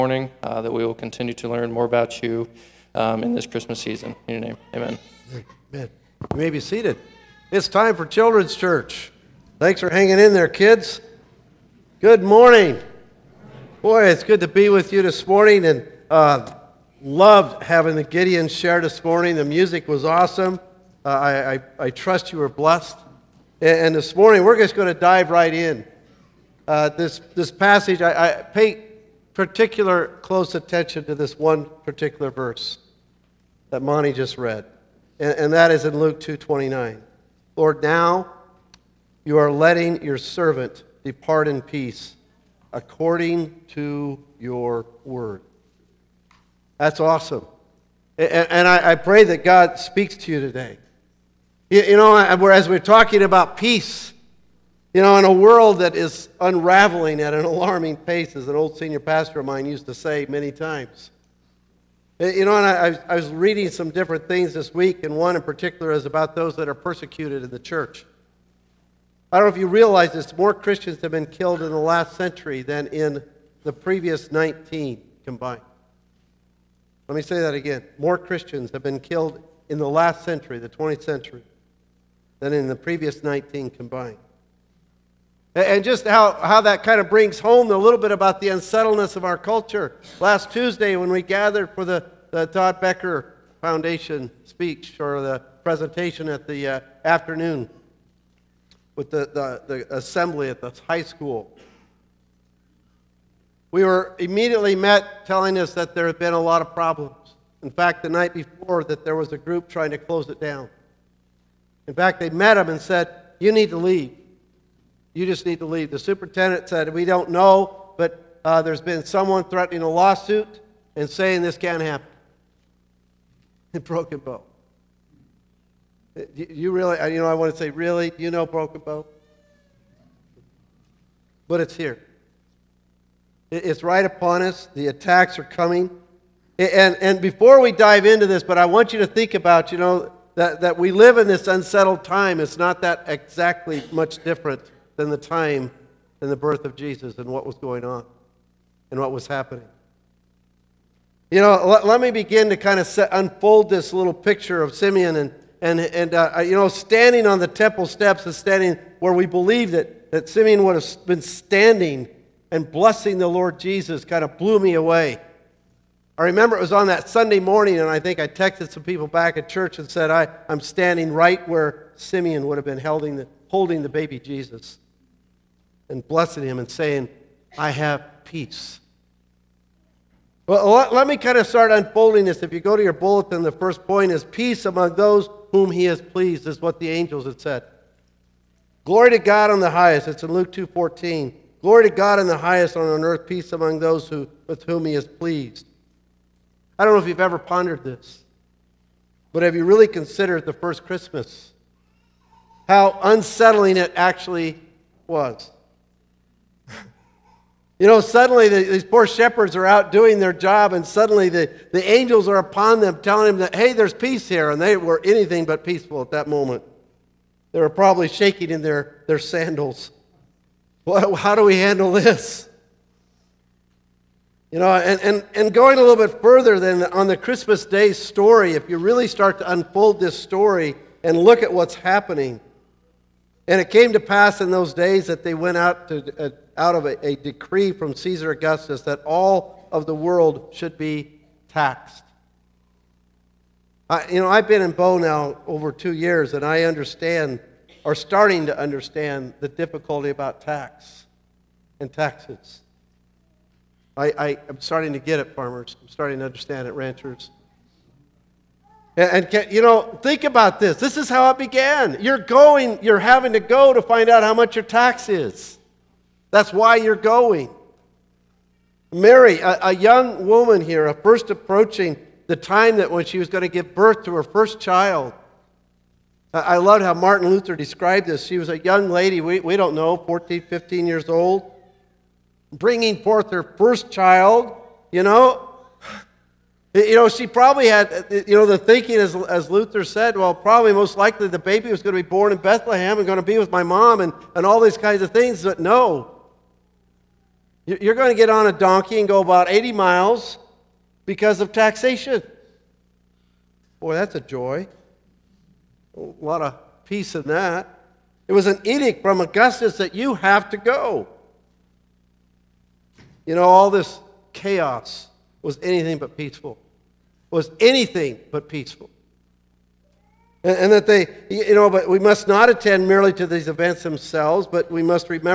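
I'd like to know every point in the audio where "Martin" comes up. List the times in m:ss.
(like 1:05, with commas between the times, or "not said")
4:36.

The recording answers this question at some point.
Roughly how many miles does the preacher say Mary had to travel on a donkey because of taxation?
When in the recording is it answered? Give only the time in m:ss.
4:59.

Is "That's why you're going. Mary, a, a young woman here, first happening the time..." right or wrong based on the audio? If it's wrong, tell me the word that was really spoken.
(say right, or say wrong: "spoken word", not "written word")
wrong: "approaching", not "happening".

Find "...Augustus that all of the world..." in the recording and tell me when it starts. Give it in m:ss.
3:58.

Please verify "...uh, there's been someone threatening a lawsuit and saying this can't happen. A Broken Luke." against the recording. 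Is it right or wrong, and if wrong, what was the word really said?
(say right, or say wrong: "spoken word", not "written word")
wrong: "Bow", not "Luke".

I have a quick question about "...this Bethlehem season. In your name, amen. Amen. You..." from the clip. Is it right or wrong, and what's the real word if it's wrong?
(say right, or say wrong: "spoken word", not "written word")
wrong: "Christmas", not "Bethlehem".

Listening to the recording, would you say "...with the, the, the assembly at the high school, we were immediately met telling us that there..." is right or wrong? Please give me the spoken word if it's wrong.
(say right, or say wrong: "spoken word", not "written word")
right.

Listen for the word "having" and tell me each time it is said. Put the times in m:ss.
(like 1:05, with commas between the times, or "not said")
0:17, 4:22.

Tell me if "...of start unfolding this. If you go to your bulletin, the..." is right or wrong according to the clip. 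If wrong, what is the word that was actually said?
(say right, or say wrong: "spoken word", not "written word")
right.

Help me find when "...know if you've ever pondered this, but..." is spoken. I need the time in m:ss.
3:16.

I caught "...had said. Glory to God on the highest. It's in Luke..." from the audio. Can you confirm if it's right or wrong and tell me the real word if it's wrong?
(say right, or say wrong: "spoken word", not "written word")
right.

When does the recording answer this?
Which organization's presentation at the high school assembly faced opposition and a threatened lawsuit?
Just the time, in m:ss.
1:32.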